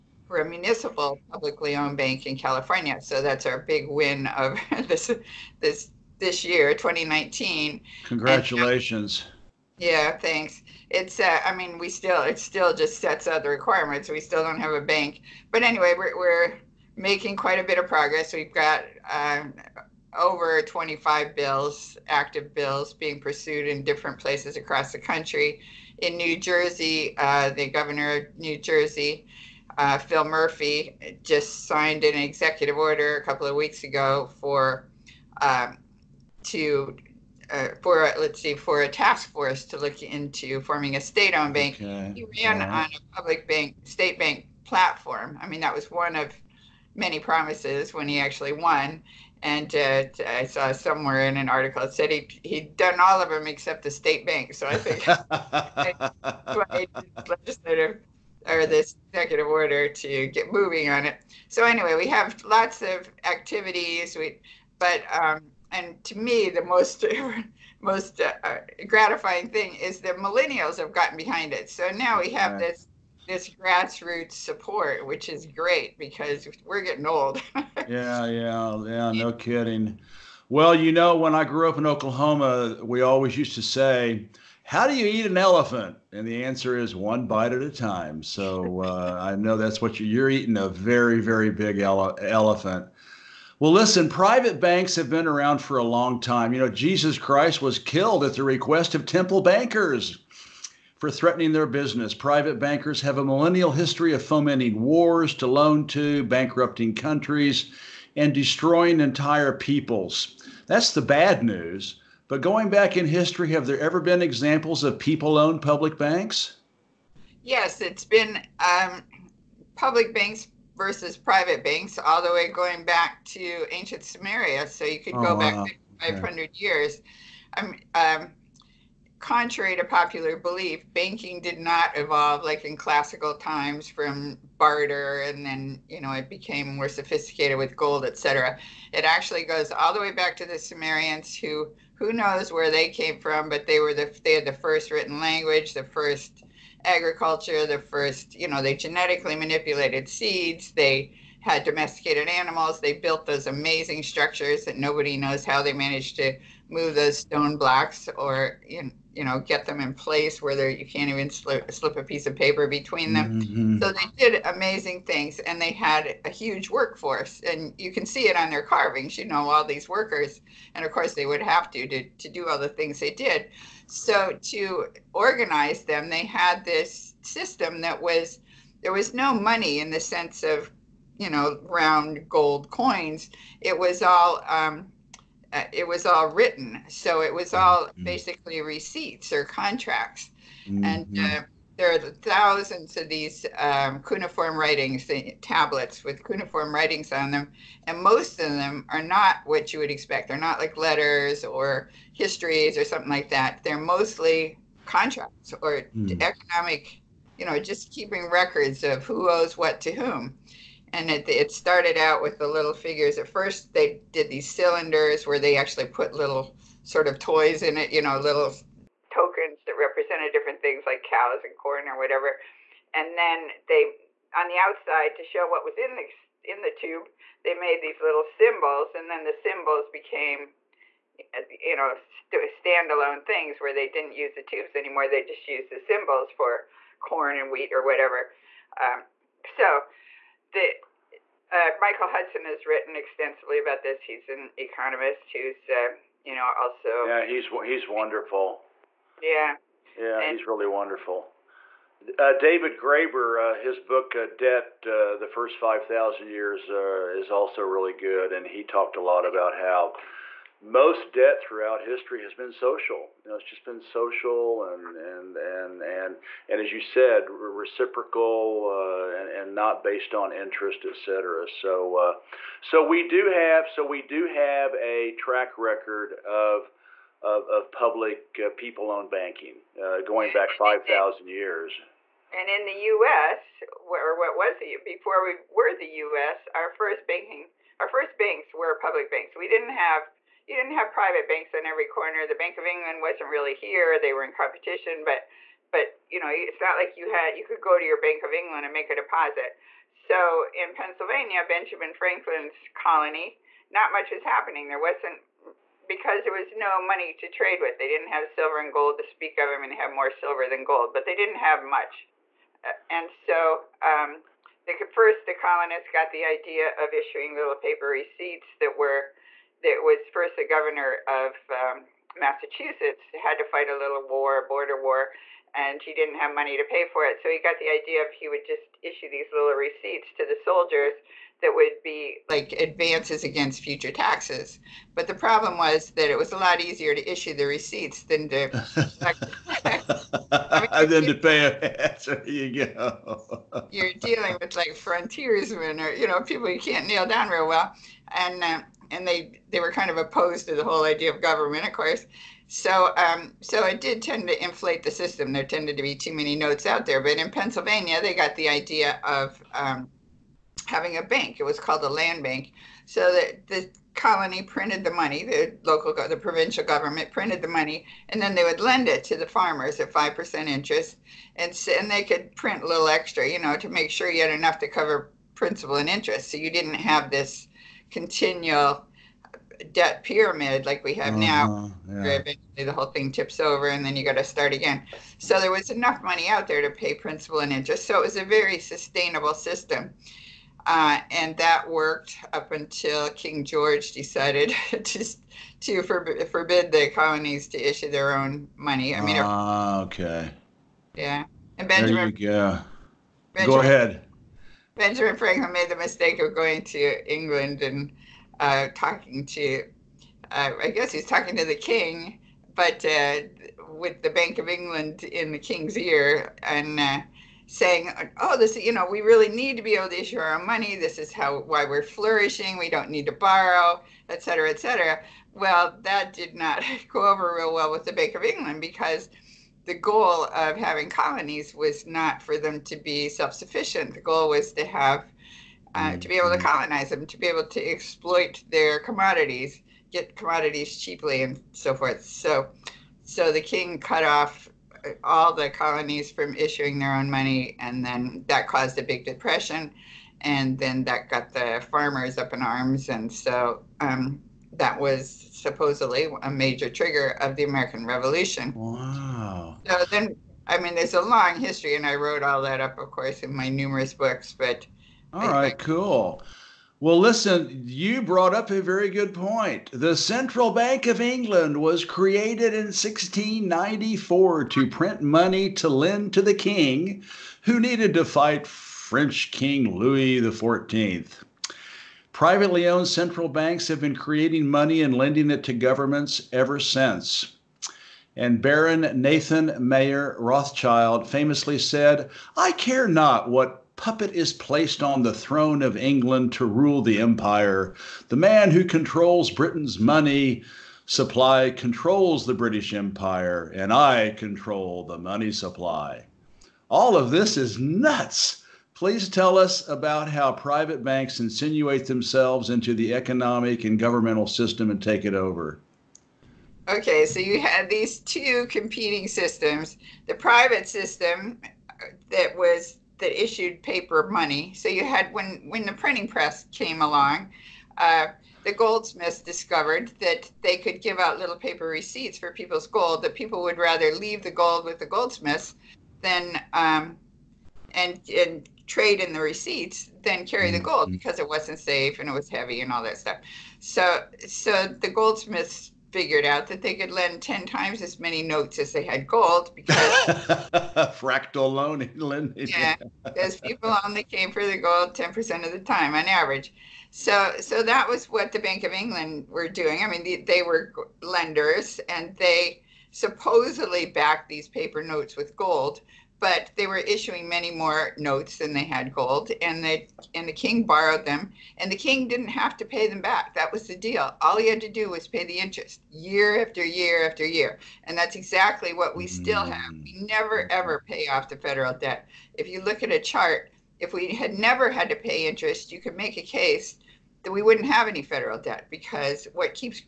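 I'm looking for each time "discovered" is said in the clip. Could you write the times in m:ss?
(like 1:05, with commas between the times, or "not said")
8:49.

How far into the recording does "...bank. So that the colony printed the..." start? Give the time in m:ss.
6:02.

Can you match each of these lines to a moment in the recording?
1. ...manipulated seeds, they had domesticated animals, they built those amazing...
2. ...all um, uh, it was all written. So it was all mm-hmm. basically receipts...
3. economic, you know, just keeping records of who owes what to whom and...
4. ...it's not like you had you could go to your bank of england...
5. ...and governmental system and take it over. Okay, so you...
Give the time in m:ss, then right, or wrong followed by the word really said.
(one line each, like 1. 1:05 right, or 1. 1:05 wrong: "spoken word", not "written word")
1. 2:29 right
2. 3:04 right
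3. 3:26 right
4. 4:56 right
5. 8:33 right.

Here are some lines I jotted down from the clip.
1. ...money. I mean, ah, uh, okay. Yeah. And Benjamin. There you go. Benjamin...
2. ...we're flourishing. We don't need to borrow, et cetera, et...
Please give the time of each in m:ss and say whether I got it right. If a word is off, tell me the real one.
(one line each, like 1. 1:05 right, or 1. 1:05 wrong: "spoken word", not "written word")
1. 6:38 right
2. 7:01 right.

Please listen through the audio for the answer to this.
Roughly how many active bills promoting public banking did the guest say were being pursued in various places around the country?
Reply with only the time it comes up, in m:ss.
0:20.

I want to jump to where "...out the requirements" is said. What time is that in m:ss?
0:13.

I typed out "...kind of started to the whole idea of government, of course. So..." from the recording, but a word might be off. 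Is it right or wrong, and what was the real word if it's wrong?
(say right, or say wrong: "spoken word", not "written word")
wrong: "opposed", not "started".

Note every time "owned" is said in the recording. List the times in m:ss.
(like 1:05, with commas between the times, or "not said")
0:01, 0:41, 1:55, 4:38, 8:02.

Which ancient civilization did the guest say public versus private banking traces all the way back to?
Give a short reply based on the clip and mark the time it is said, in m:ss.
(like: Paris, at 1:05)
Sumeria, at 2:04.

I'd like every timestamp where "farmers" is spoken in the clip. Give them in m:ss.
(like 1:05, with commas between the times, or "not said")
6:09, 7:31.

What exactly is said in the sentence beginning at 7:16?
colonize them, to be able to exploit their commodities, get commodities cheaply, and so forth.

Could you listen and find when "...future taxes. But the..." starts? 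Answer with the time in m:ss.
5:33.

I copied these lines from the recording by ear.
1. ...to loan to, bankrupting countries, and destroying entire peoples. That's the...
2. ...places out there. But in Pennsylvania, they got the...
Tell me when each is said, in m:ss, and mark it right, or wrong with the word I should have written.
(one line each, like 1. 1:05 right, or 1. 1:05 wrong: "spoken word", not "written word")
1. 1:45 right
2. 5:56 wrong: "notes", not "places".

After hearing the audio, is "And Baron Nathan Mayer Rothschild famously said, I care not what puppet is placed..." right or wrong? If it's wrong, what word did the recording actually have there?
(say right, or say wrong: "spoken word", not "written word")
right.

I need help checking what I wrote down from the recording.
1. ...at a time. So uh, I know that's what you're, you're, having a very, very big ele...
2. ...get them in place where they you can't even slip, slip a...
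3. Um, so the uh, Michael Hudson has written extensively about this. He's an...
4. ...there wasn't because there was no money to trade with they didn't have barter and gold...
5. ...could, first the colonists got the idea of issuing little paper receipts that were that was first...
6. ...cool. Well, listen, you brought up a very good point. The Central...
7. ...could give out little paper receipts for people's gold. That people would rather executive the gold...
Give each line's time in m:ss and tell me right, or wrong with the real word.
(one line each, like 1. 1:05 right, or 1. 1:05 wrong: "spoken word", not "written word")
1. 1:27 wrong: "eating", not "having"
2. 2:39 right
3. 3:58 right
4. 5:04 wrong: "silver", not "barter"
5. 5:14 right
6. 7:45 right
7. 8:50 wrong: "leave", not "executive".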